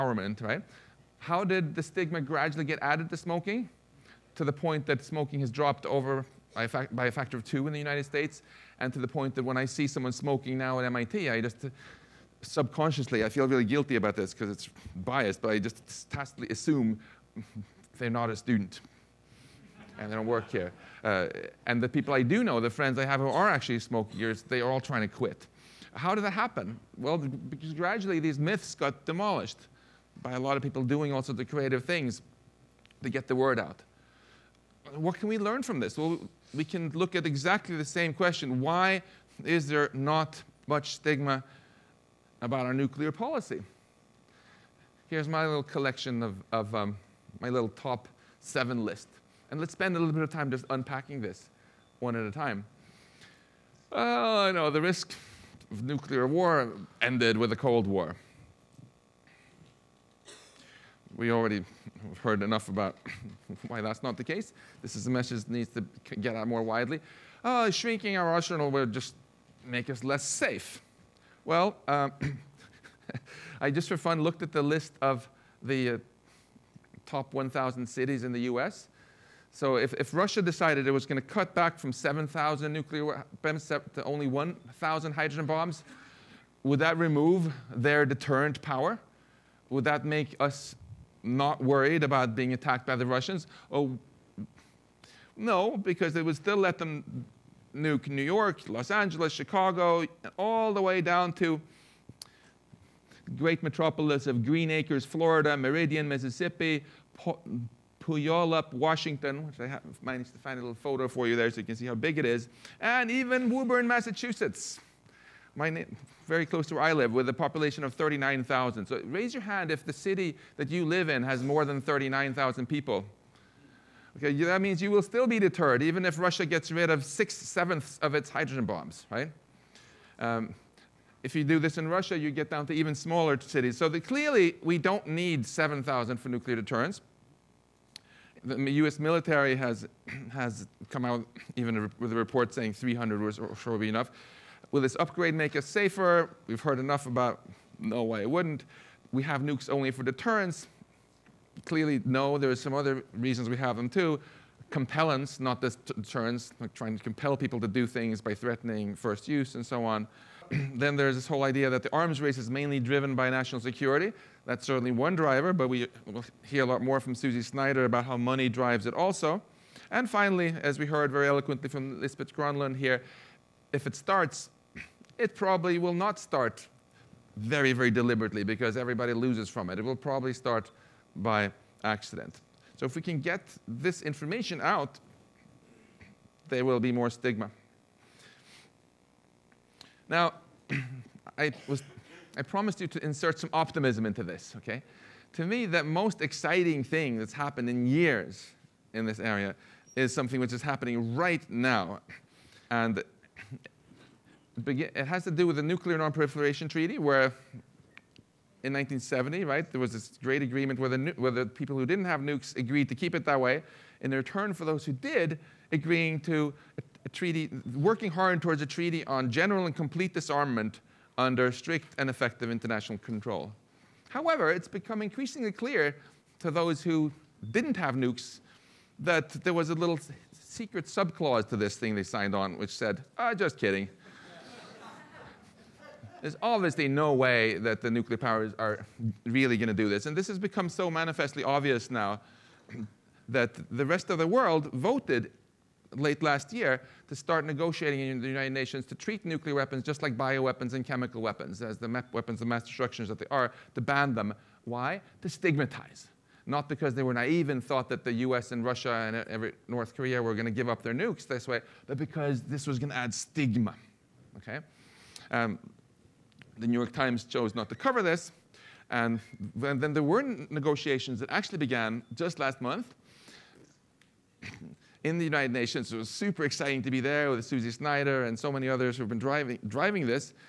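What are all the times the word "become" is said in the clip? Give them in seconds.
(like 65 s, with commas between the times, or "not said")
224 s, 240 s.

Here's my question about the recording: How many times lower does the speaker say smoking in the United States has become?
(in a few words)
2.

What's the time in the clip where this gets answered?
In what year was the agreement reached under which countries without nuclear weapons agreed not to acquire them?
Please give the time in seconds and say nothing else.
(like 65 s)
208 s.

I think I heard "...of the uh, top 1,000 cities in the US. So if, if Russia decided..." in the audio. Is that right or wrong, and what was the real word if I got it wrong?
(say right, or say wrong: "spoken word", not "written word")
right.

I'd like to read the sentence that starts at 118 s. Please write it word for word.
So raise your hand if the city that you live in has more than 39,000 people.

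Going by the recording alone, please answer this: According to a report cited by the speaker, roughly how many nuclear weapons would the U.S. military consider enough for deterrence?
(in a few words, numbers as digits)
300.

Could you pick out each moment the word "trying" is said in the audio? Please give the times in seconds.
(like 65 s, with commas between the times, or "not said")
24 s, 156 s.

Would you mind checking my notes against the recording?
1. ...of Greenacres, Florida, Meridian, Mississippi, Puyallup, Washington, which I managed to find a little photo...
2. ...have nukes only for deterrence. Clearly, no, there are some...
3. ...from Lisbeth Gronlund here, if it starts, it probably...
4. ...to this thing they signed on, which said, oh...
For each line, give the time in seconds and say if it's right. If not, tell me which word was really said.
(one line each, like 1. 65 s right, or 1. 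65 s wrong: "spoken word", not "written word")
1. 104 s right
2. 149 s right
3. 171 s right
4. 231 s right.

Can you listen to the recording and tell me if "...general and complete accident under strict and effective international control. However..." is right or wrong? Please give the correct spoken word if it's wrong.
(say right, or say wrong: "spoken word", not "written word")
wrong: "disarmament", not "accident".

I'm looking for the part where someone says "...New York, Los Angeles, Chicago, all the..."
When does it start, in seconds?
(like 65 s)
98 s.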